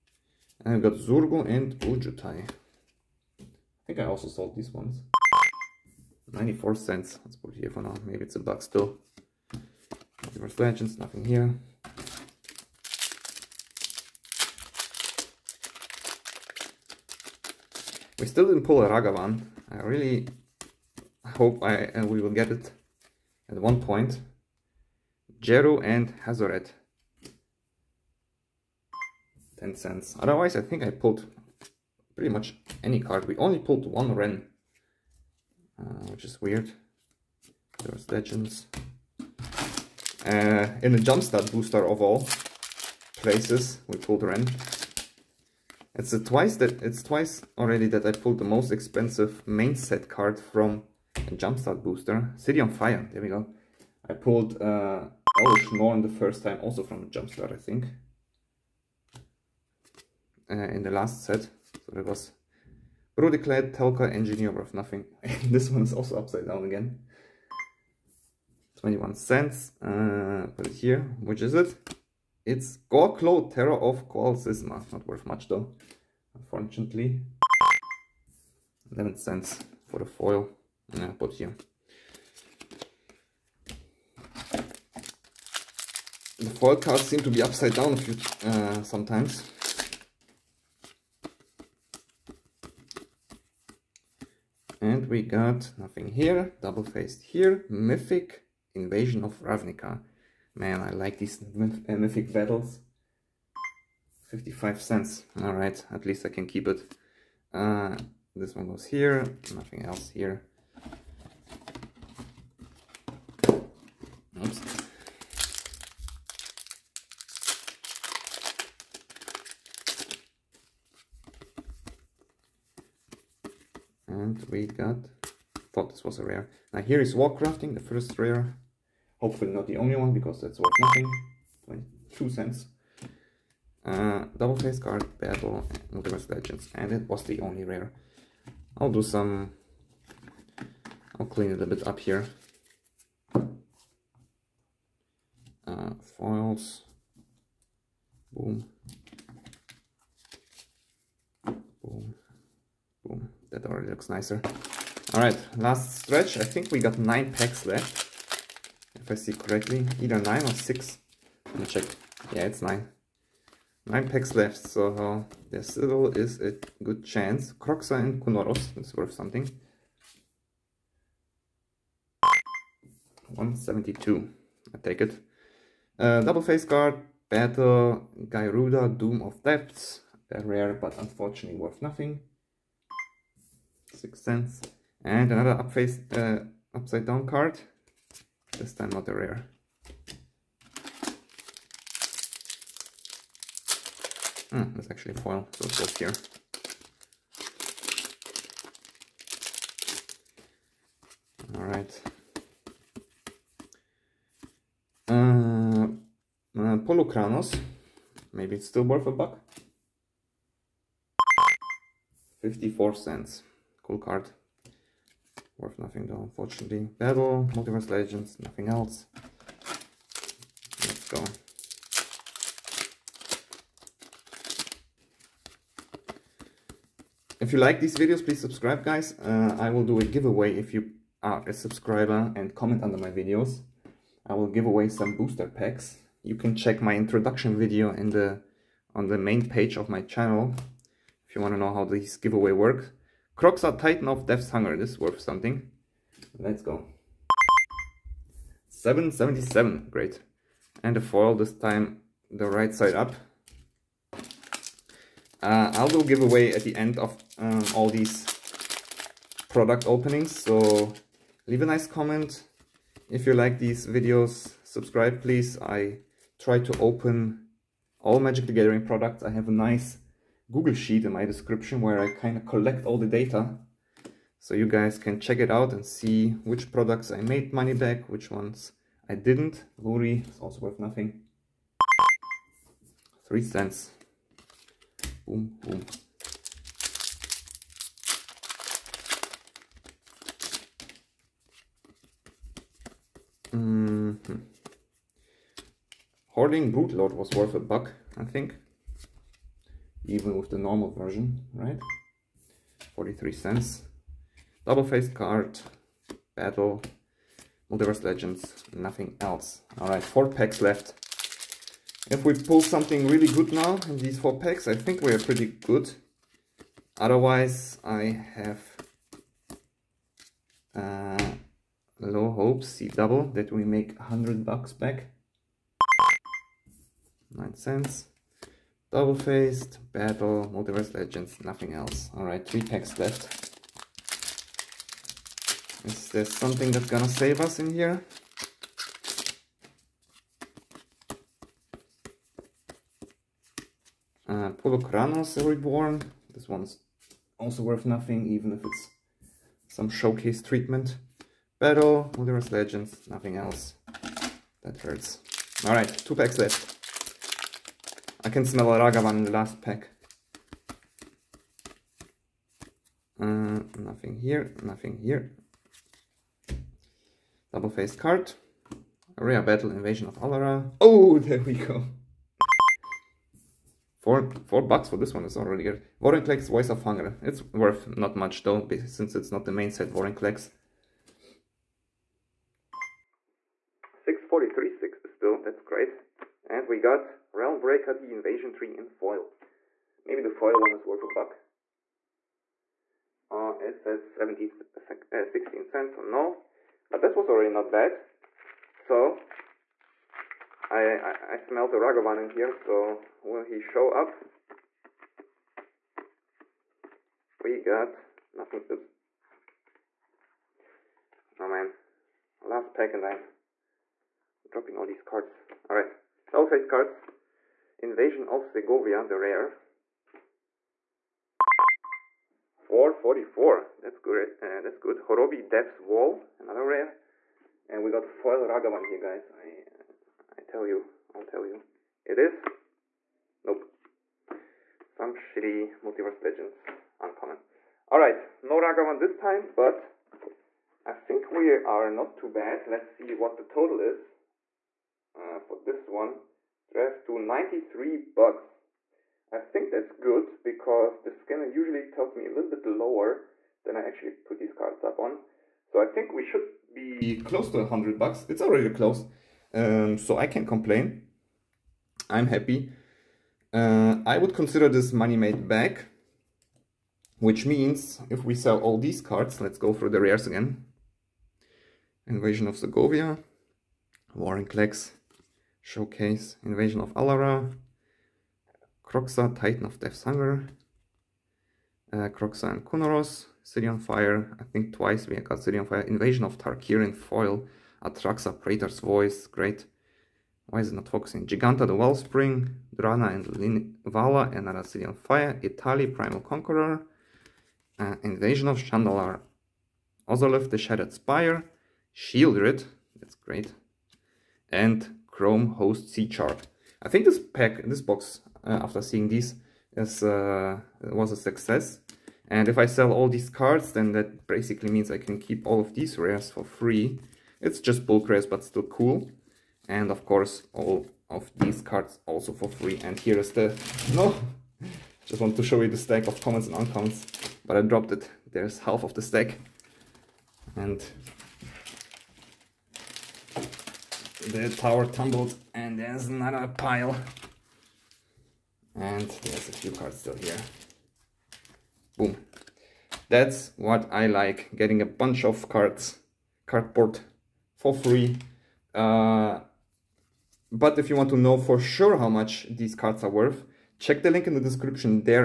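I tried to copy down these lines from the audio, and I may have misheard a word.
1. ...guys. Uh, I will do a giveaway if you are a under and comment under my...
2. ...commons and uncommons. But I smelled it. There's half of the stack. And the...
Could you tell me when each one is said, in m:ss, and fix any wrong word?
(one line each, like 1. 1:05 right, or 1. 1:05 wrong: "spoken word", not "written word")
1. 3:48 wrong: "subscriber", not "under"
2. 8:46 wrong: "dropped", not "smelled".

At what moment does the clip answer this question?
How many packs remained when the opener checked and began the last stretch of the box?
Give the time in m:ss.
2:42.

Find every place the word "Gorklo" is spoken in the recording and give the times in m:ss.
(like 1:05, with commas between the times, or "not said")
1:12.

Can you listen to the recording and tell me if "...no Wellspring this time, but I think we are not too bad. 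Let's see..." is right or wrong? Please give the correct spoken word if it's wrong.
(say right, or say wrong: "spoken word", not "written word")
wrong: "Ragavan", not "Wellspring".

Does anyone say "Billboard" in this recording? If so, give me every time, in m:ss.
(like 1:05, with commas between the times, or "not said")
not said.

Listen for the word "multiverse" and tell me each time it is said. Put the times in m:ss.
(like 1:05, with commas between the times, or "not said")
2:15, 3:37, 5:07, 5:30, 5:52, 7:15.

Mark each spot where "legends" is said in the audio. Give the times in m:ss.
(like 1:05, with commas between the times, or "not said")
0:10, 0:38, 2:16, 3:37, 5:08, 5:30, 5:52, 7:16.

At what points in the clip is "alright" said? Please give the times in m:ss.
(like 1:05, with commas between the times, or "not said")
1:45, 3:21, 5:09, 5:32, 5:55, 6:55.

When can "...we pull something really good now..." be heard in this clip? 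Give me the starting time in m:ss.
5:12.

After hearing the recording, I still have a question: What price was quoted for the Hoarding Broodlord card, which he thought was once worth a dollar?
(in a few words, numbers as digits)
43 cents.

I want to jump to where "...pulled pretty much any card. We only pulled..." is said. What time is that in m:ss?
0:30.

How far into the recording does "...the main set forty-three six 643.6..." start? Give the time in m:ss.
6:19.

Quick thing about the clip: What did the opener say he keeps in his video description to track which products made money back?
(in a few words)
Google Sheet.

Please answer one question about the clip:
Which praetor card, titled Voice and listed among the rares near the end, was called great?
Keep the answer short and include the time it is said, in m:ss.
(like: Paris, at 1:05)
Atraxa, at 8:07.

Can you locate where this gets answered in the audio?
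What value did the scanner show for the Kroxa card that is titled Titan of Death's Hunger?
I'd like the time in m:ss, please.
4:08.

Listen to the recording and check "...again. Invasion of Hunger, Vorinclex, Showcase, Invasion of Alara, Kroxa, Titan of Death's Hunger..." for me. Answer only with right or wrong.
wrong.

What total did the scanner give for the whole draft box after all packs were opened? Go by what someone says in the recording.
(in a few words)
93 bucks.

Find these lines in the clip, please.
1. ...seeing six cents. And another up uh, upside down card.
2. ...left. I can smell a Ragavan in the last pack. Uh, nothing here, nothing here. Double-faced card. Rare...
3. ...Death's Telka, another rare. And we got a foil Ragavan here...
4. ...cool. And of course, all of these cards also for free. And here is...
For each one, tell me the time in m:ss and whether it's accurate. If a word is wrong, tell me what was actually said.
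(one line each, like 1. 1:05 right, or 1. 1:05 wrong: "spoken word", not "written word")
1. 3:01 wrong: "nothing", not "seeing"
2. 5:56 right
3. 7:05 wrong: "Wail", not "Telka"
4. 8:38 right.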